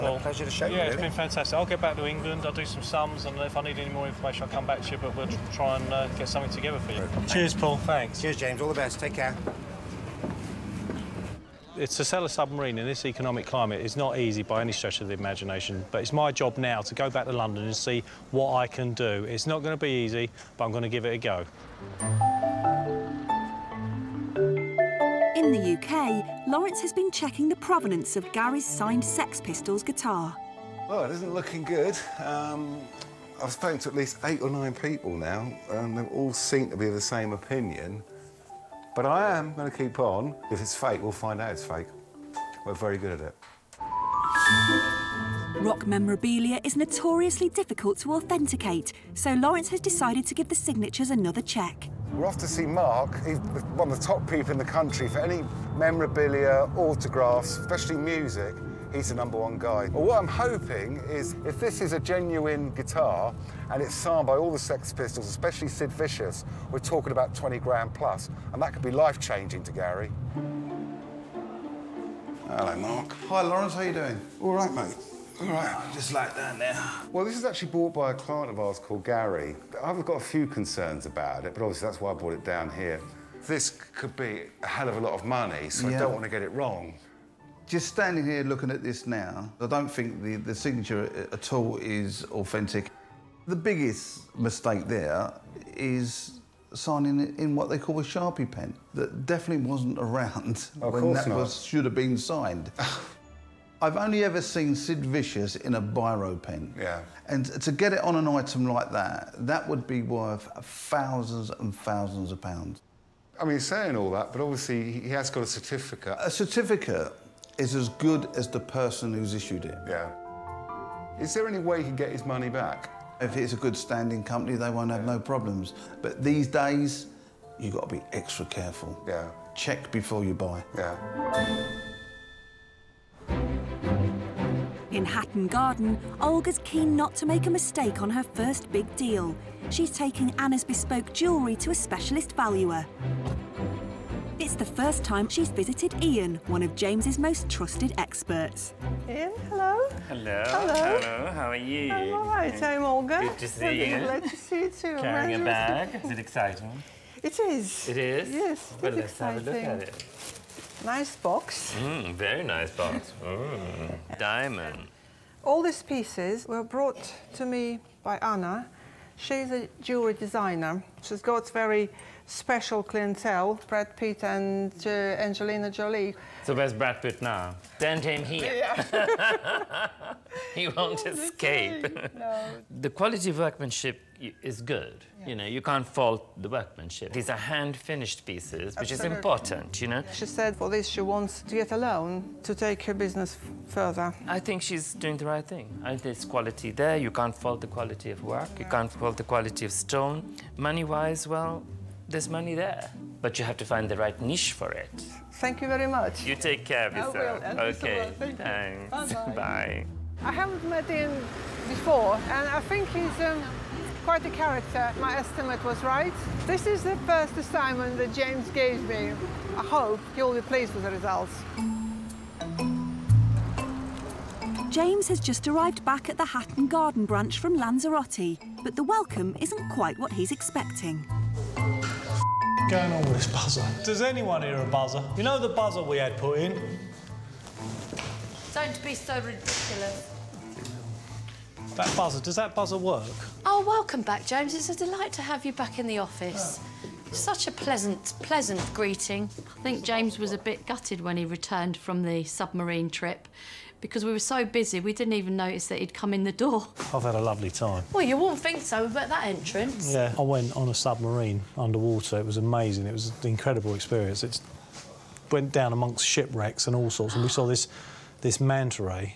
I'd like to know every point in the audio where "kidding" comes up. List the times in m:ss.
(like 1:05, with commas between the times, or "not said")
not said.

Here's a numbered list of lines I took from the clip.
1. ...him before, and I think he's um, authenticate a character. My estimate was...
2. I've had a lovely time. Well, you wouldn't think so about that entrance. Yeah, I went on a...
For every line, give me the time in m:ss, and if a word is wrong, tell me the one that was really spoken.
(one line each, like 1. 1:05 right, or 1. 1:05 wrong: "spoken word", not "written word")
1. 3:30 wrong: "quite", not "authenticate"
2. 4:16 right.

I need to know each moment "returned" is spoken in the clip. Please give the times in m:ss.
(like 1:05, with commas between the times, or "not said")
4:11.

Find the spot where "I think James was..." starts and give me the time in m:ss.
4:09.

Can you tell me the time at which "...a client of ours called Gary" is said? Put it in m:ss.
1:18.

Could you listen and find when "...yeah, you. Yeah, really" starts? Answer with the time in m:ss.
0:00.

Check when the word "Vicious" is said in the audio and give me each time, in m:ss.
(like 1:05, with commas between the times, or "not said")
1:05, 1:45.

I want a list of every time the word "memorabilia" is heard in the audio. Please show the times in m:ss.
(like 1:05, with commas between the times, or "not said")
0:45, 0:55.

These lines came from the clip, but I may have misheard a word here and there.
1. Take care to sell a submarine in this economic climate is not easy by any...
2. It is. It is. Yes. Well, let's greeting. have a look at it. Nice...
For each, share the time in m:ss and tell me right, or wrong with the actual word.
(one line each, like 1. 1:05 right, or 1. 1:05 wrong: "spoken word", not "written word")
1. 0:08 right
2. 2:37 wrong: "exciting", not "greeting".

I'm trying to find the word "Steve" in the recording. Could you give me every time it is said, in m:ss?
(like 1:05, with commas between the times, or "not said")
not said.